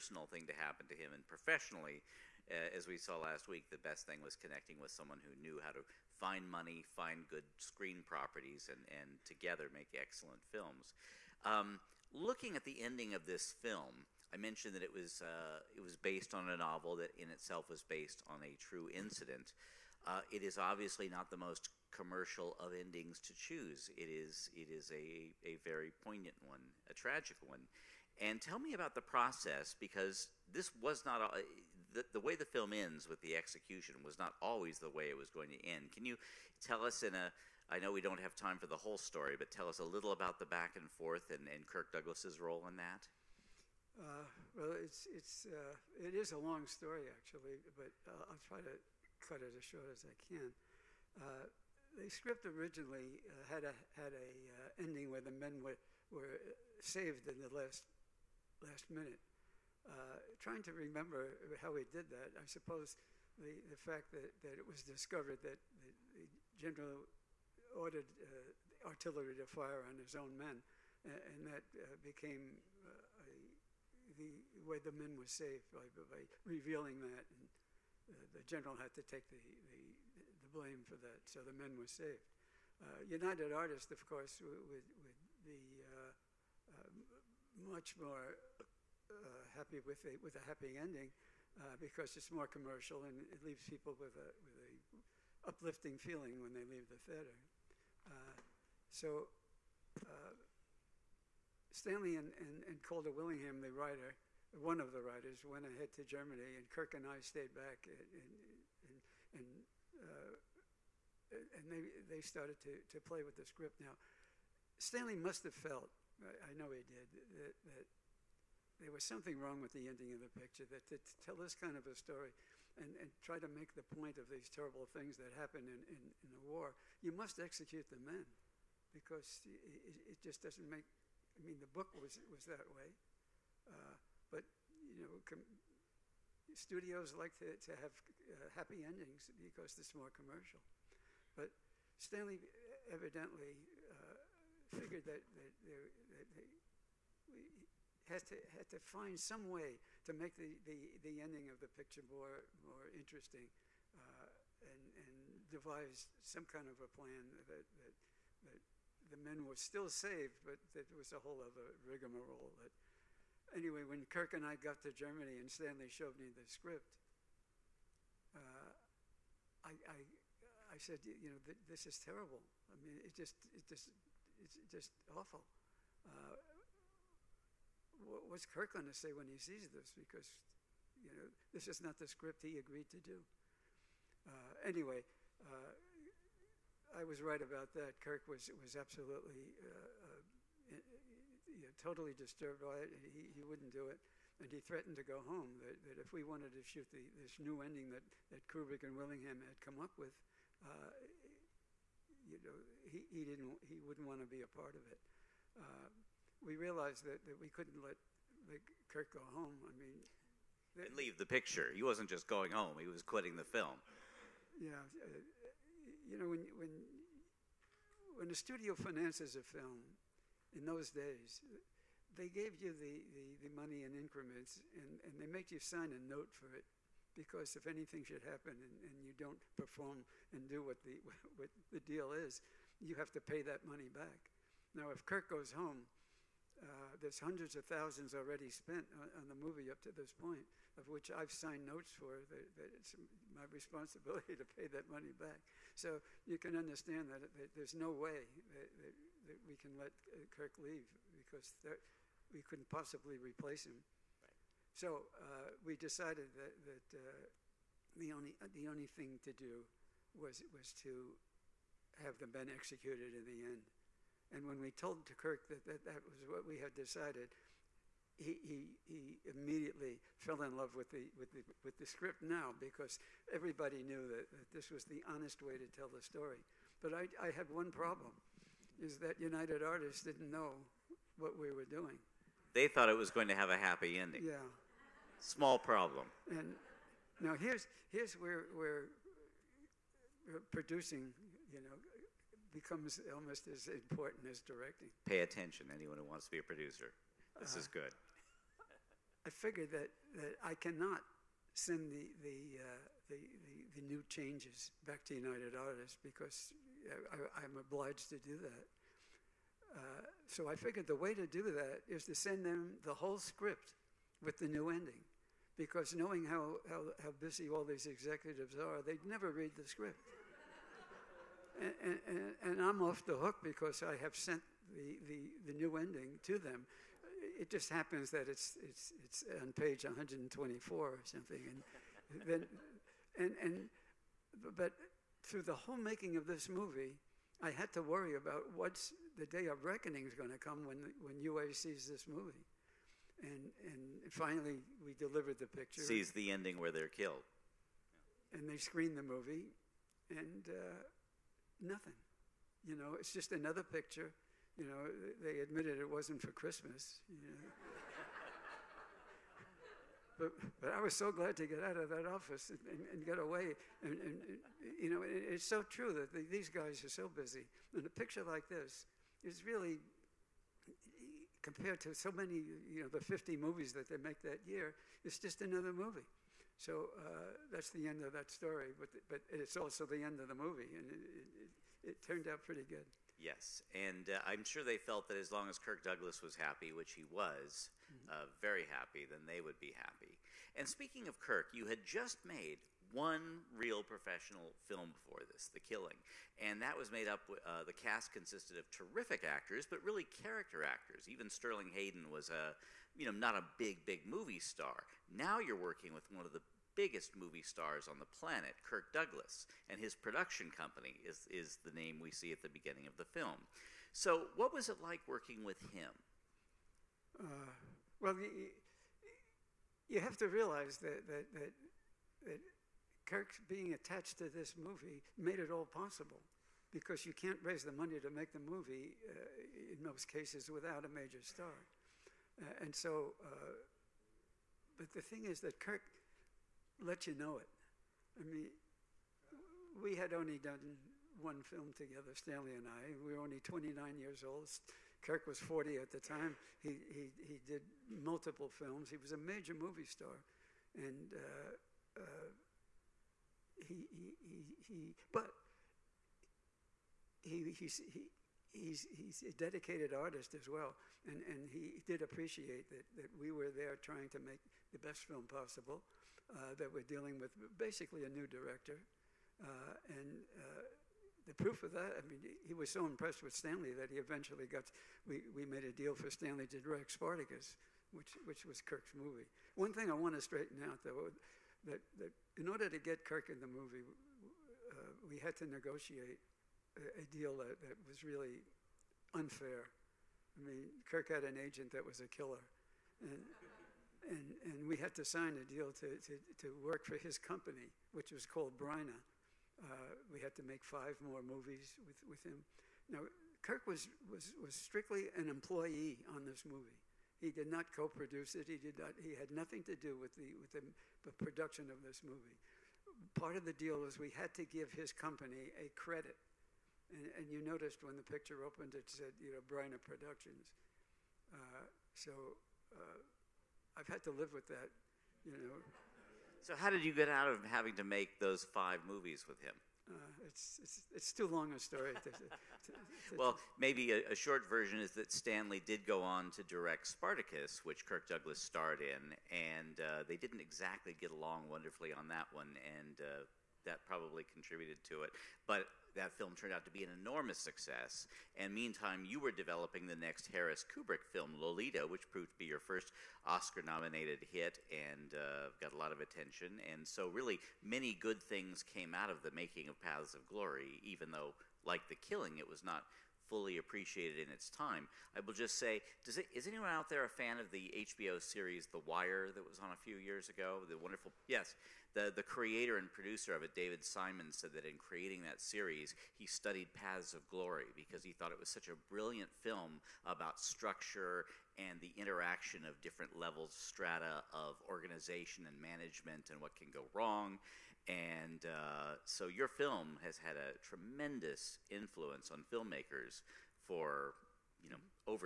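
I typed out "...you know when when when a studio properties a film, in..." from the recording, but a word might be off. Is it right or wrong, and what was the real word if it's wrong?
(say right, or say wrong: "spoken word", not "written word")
wrong: "finances", not "properties".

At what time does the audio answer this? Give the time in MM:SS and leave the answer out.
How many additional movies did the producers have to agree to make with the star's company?
08:20.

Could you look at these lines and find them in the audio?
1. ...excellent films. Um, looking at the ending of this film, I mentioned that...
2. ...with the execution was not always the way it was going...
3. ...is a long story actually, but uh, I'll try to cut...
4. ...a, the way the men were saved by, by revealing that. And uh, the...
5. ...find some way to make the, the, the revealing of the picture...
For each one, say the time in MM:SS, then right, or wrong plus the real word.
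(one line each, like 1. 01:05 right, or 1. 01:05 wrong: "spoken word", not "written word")
1. 00:09 right
2. 00:33 right
3. 00:46 right
4. 01:13 right
5. 02:28 wrong: "ending", not "revealing".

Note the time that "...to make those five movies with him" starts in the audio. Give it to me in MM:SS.
08:47.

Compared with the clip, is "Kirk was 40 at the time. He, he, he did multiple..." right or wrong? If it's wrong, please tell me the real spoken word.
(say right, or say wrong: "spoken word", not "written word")
right.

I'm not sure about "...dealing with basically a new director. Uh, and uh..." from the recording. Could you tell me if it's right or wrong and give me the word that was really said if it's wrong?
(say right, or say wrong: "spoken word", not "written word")
right.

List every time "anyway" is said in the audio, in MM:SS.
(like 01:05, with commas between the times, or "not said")
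02:43, 03:04.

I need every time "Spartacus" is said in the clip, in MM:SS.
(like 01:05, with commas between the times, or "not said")
07:56, 08:56.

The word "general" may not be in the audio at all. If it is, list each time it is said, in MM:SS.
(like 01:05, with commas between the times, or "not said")
01:06, 01:18.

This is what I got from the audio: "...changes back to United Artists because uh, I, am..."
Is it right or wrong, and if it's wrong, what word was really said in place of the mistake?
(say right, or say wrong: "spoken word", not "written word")
right.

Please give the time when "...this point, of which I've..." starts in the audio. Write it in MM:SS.
03:59.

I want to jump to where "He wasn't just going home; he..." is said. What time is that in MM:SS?
03:31.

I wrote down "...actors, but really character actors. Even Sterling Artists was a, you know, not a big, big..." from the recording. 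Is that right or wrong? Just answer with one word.
wrong.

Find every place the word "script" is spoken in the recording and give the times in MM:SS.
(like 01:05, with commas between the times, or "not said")
00:52, 01:53, 02:46, 03:02, 04:31, 05:13, 05:19.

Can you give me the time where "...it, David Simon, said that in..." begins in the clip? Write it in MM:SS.
09:33.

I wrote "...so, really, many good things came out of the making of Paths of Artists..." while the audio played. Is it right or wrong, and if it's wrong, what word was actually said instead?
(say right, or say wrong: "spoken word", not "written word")
wrong: "Glory", not "Artists".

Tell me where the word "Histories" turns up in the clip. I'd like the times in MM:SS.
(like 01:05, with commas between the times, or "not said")
not said.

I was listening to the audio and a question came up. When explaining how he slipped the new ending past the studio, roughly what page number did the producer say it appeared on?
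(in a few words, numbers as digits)
124.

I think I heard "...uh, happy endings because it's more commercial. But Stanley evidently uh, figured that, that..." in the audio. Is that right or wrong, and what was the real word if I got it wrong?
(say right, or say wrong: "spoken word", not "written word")
right.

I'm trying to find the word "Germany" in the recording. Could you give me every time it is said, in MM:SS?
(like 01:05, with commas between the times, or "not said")
01:46, 02:44.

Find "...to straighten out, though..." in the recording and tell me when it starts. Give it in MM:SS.
08:00.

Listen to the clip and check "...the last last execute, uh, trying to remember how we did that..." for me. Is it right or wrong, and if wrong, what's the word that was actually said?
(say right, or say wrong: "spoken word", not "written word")
wrong: "minute", not "execute".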